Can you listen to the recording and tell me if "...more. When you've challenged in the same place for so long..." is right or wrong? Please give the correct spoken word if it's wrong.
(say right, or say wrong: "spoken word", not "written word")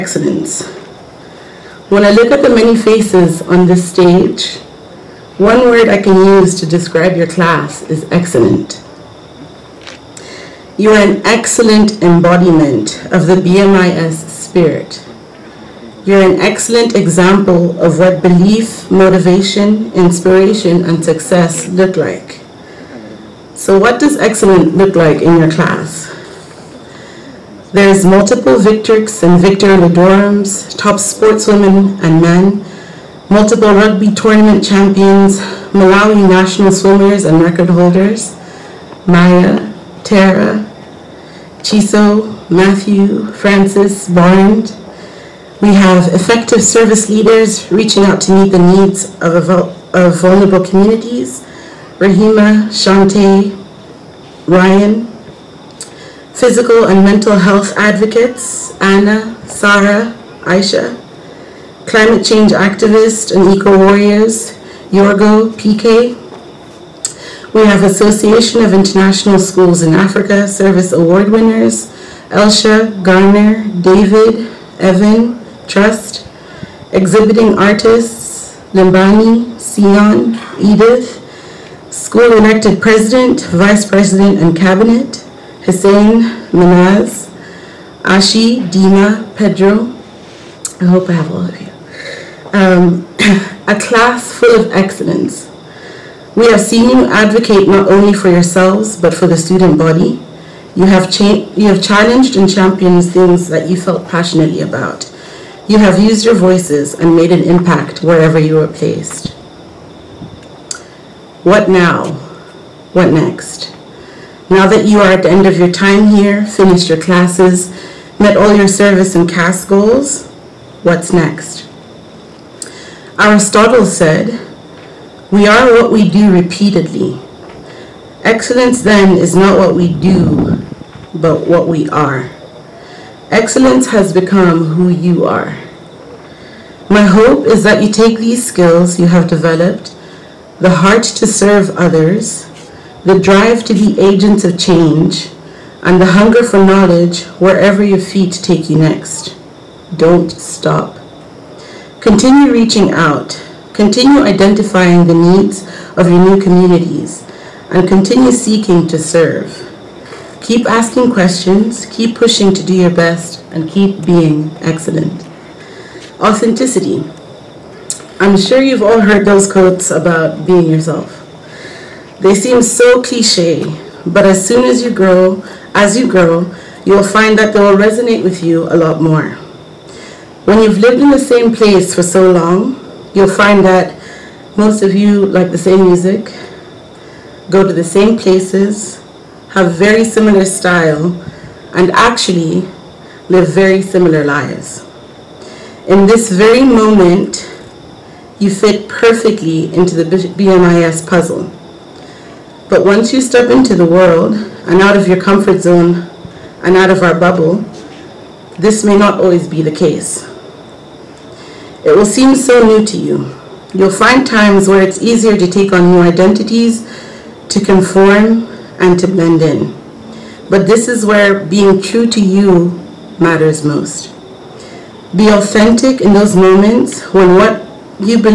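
wrong: "lived", not "challenged".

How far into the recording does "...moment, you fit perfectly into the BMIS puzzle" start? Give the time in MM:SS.
03:16.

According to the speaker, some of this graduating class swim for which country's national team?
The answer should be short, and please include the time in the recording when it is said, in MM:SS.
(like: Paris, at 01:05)
Malawi, at 00:35.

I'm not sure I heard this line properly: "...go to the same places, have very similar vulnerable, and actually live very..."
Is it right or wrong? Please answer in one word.
wrong.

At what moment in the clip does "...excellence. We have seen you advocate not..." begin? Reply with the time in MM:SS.
01:34.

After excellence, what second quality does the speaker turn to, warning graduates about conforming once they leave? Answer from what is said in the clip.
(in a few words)
Authenticity.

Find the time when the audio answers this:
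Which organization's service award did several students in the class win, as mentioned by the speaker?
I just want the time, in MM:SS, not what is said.
01:07.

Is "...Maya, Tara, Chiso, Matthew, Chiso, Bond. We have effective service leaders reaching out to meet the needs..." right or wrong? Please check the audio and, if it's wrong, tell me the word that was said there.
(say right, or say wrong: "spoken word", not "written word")
wrong: "Francis", not "Chiso".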